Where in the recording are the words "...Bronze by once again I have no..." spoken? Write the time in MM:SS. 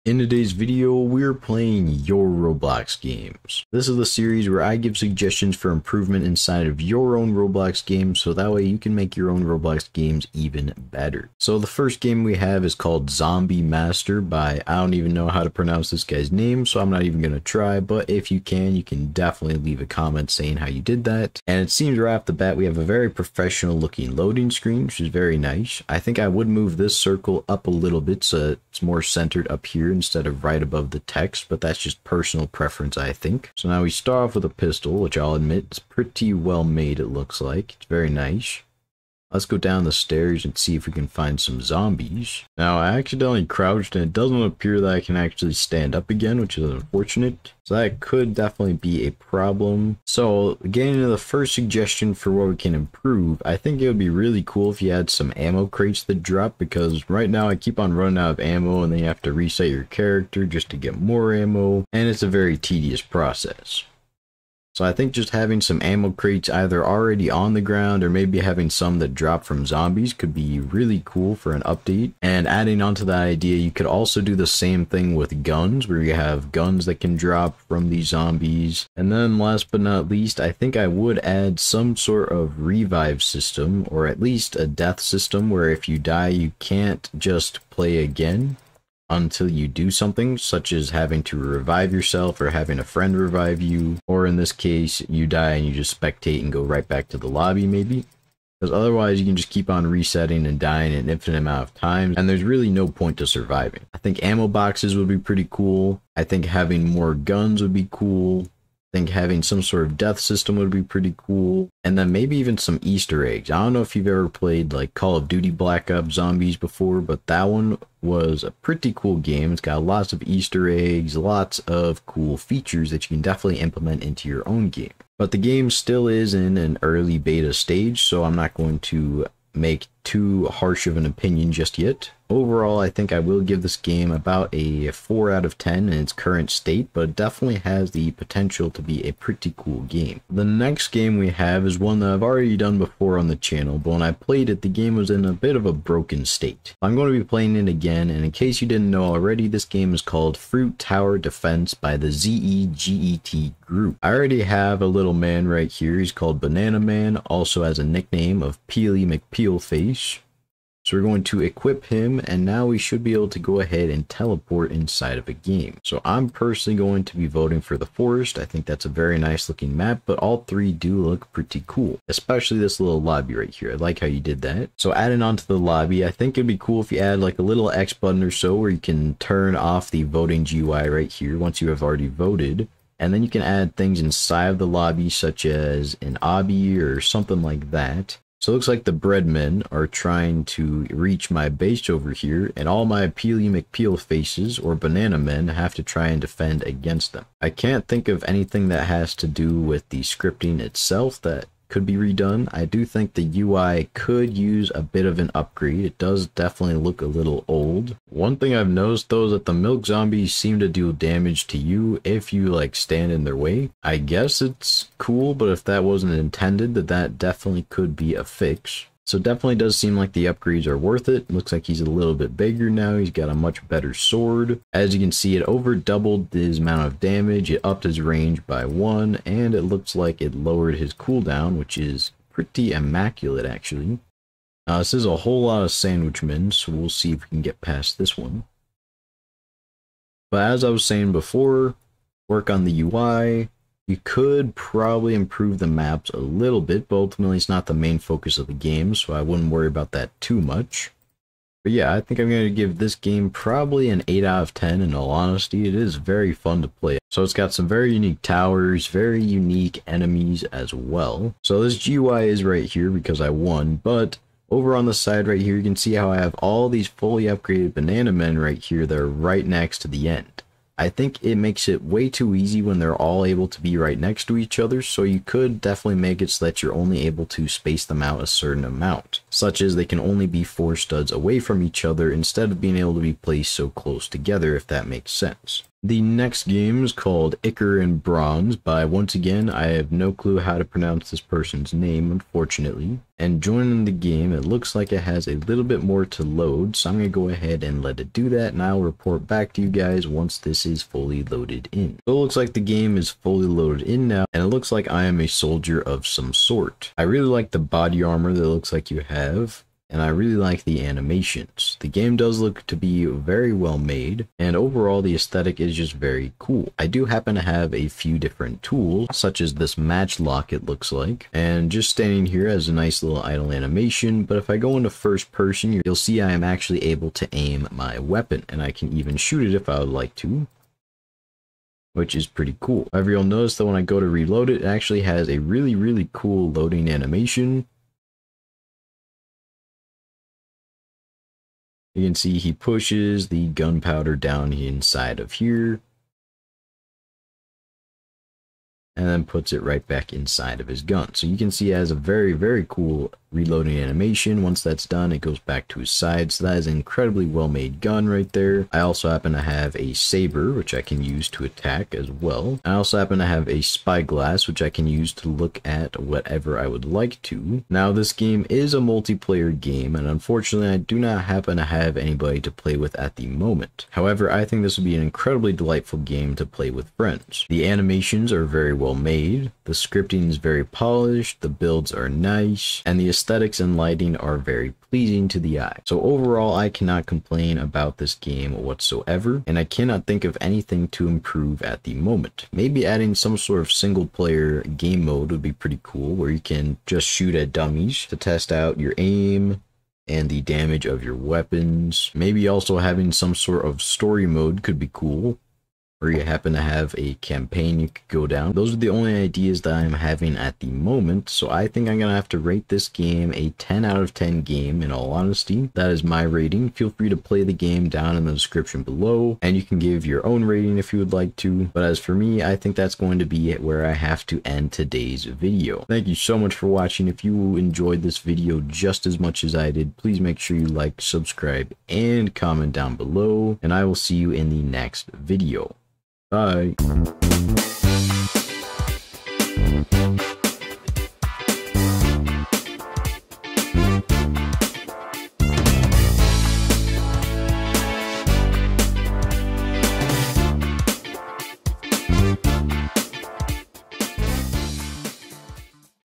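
04:48.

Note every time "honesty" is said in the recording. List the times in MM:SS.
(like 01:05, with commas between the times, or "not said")
04:15, 06:55.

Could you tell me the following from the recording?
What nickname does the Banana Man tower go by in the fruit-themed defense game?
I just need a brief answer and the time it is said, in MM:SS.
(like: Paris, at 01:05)
Peely McPeel Face, at 02:38.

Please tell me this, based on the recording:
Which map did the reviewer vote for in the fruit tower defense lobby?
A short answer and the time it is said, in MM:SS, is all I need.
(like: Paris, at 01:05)
the forest, at 02:47.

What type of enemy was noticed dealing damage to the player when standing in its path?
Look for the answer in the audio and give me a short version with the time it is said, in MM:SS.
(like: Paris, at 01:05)
milk zombies, at 03:29.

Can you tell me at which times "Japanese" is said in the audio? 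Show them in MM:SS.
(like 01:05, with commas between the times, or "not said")
not said.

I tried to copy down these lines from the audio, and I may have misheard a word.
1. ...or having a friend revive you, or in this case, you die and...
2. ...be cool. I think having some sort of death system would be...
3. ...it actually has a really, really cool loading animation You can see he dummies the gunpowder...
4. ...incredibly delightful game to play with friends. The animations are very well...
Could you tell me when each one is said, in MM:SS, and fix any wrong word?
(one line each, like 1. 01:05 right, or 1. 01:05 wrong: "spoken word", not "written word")
1. 01:32 right
2. 01:47 right
3. 05:34 wrong: "pushes", not "dummies"
4. 06:15 right.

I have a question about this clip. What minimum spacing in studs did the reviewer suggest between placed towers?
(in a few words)
4.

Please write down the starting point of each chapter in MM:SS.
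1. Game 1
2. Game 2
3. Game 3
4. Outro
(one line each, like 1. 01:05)
1. 00:11
2. 02:28
3. 04:45
4. 07:02.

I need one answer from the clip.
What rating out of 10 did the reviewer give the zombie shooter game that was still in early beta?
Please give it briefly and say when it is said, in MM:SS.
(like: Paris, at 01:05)
4, at 02:14.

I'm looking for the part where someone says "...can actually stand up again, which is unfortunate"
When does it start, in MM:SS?
00:44.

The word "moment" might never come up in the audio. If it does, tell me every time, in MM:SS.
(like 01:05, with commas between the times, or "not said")
06:13, 06:31, 06:50.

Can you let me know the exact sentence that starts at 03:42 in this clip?
He's got a much better sword.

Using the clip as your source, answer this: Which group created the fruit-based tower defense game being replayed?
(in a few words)
ZEGET Group.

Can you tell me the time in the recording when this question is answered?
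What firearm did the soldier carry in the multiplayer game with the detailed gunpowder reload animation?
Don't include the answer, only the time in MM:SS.
05:19.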